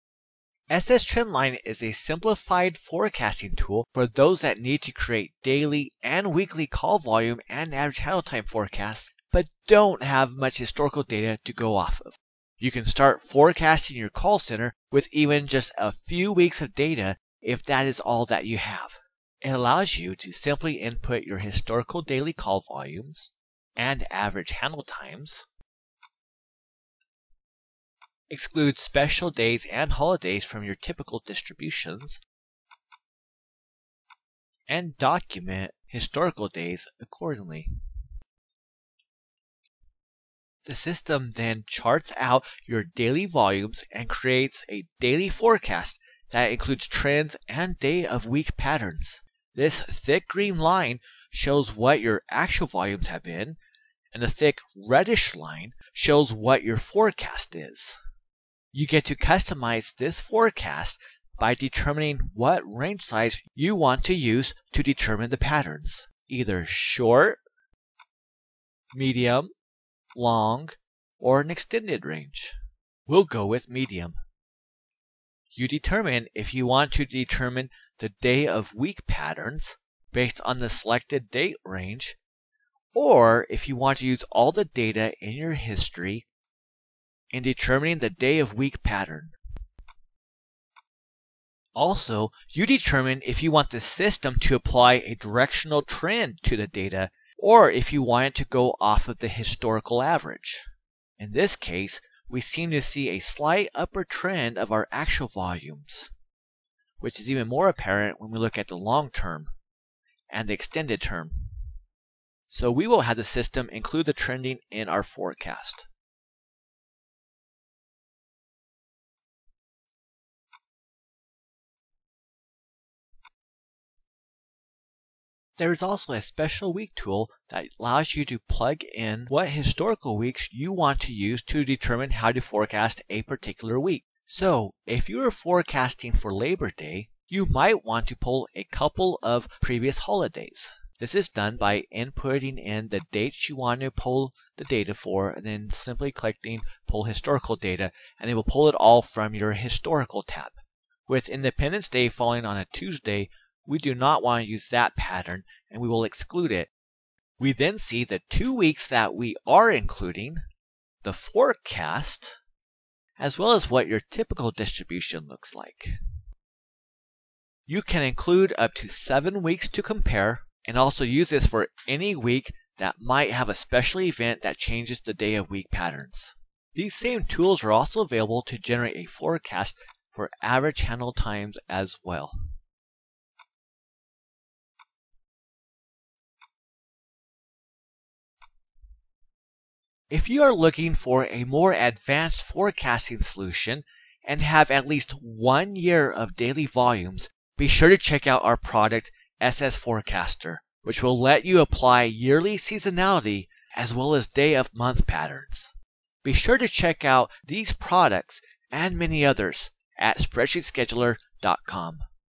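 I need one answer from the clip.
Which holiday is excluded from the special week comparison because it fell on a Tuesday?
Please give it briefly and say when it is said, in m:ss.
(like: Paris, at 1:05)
Independence Day, at 2:31.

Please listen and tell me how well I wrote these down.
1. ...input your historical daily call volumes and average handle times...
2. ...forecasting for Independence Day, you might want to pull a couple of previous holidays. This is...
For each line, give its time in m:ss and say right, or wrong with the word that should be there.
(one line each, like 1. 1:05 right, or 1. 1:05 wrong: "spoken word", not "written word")
1. 0:20 right
2. 2:15 wrong: "Labor", not "Independence".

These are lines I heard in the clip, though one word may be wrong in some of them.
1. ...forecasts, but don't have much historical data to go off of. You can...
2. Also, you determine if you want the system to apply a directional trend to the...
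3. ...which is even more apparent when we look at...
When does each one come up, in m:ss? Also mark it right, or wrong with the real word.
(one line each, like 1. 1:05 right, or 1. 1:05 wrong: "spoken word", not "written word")
1. 0:08 right
2. 1:31 right
3. 1:46 right.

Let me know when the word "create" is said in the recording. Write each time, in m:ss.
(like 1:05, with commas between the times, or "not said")
0:04, 0:44.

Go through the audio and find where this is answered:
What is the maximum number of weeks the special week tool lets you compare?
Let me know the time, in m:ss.
2:48.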